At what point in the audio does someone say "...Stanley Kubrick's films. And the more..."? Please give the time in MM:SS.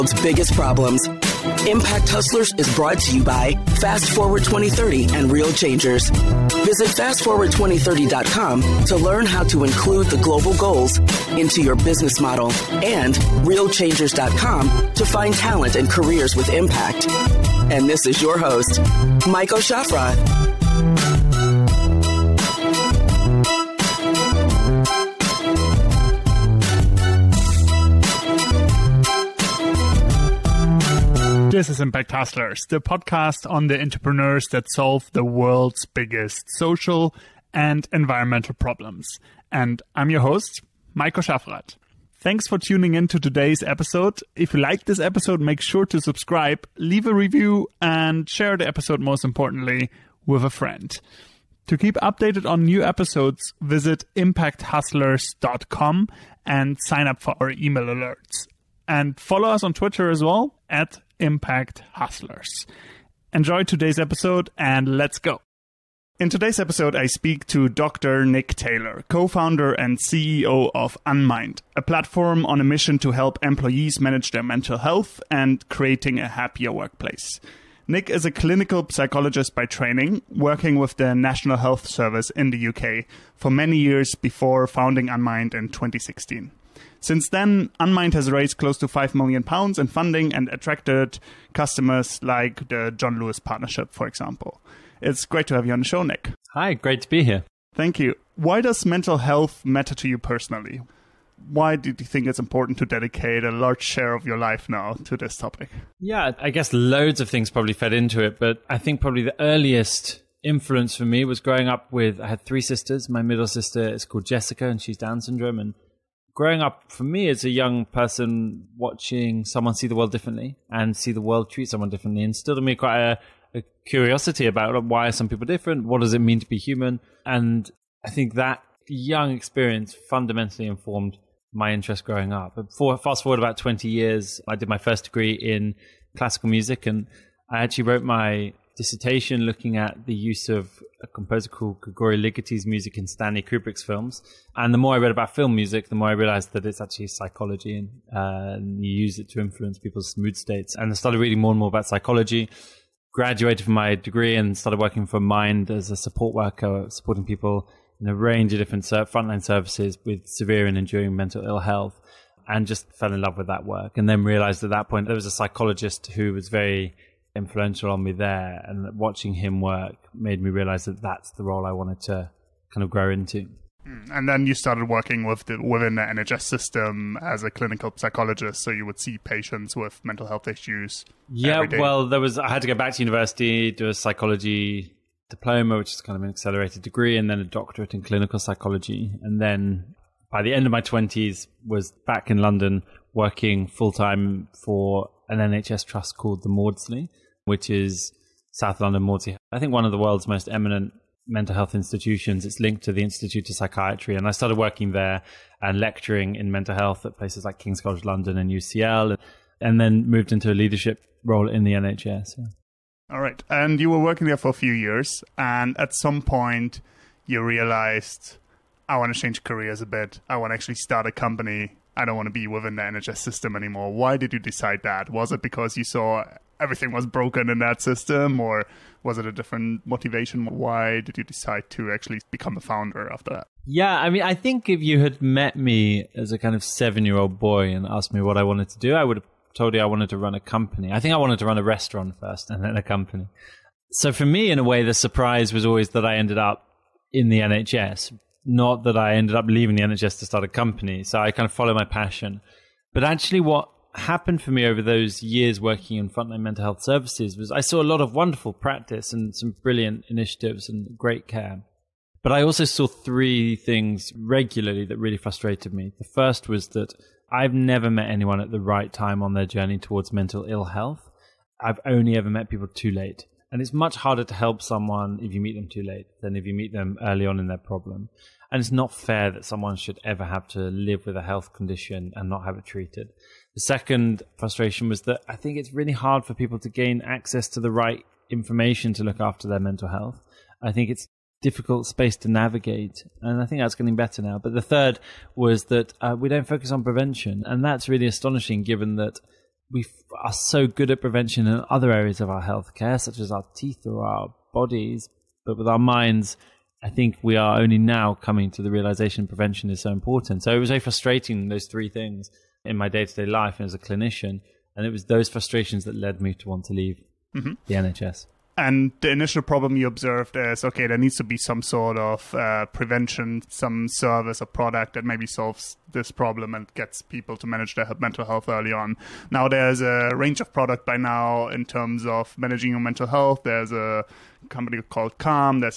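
02:23.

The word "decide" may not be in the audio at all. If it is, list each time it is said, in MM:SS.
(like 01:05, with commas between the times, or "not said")
03:44, 03:51.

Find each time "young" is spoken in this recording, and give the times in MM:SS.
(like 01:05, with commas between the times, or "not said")
01:57, 02:08.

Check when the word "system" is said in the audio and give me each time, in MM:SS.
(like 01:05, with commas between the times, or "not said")
02:56, 03:43, 03:47.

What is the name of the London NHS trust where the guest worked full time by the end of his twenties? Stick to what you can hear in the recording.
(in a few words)
South London Maudsley.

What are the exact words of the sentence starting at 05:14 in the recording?
And it was those frustrations that led me to want to leave mm-hmm.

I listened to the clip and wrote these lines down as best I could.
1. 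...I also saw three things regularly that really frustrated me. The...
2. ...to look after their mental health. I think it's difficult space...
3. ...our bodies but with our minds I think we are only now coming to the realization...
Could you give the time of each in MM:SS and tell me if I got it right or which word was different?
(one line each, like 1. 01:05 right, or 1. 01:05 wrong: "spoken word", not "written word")
1. 04:22 right
2. 04:48 right
3. 05:04 right.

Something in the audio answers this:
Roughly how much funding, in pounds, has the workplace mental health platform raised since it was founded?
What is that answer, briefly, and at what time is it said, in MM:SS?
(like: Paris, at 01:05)
5 million pounds, at 01:28.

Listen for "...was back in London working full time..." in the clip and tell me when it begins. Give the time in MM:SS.
03:11.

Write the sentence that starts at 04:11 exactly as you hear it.
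So I kind of follow my passion.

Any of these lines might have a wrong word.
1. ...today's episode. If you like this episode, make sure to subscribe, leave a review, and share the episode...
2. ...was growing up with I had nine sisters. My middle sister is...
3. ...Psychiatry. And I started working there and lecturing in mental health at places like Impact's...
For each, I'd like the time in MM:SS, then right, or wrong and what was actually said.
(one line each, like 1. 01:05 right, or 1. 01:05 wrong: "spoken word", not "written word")
1. 00:43 right
2. 01:51 wrong: "three", not "nine"
3. 03:23 wrong: "King", not "Impact".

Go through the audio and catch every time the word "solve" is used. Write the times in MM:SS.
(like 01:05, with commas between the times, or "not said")
00:34, 05:25.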